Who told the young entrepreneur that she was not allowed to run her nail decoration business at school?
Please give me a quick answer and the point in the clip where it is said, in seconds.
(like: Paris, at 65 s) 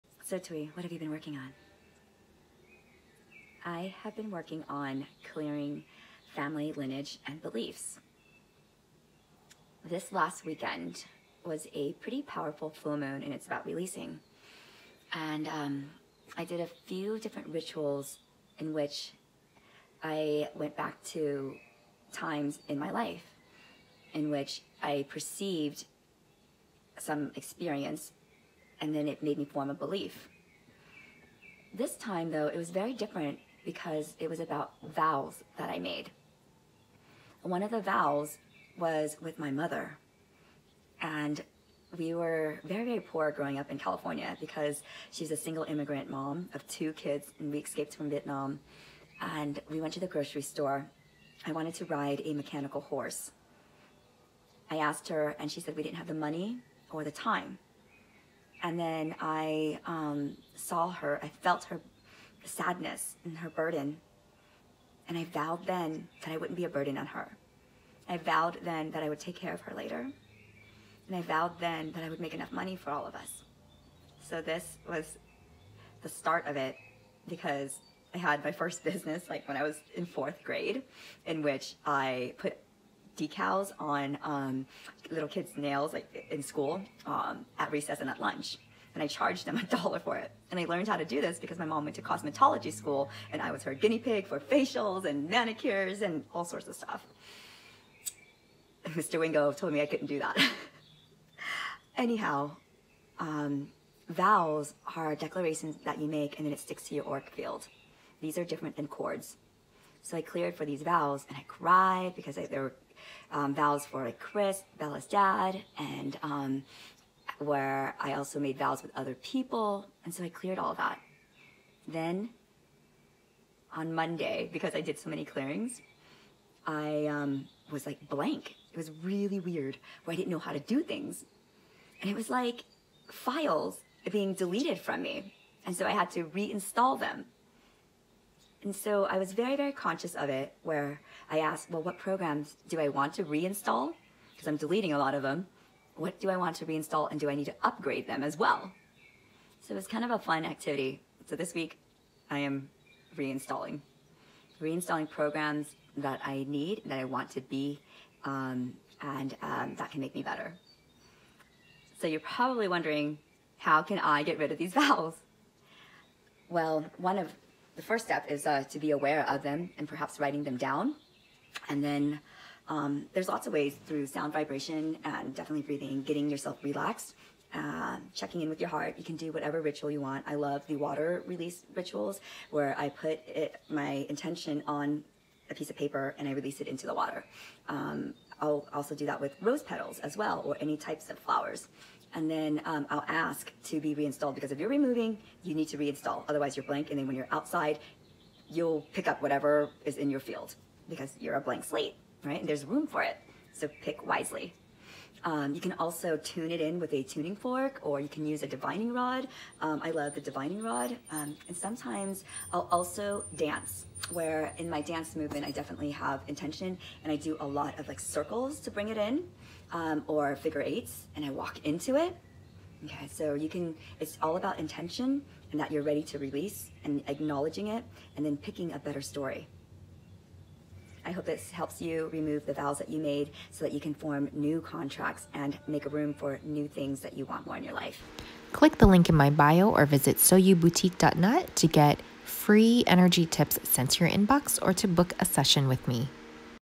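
Mr. Wingo, at 98 s.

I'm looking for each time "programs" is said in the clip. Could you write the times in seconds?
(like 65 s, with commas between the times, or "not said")
141 s, 155 s.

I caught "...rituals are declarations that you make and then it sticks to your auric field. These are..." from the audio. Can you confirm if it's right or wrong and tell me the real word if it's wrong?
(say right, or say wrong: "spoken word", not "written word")
wrong: "vowels", not "rituals".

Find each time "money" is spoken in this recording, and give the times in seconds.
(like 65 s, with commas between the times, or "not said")
56 s, 72 s.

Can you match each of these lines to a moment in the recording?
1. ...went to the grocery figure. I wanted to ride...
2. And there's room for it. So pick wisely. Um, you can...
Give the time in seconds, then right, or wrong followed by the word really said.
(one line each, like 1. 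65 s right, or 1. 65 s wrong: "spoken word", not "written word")
1. 49 s wrong: "store", not "figure"
2. 202 s right.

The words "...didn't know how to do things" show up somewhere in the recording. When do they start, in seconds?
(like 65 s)
130 s.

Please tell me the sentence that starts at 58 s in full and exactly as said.
And then I um, saw her, I felt her sadness and her burden.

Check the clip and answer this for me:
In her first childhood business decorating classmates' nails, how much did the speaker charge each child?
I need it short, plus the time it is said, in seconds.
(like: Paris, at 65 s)
$1, at 89 s.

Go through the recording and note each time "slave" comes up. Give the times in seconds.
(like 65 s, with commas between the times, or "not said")
not said.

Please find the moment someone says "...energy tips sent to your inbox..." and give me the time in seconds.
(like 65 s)
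242 s.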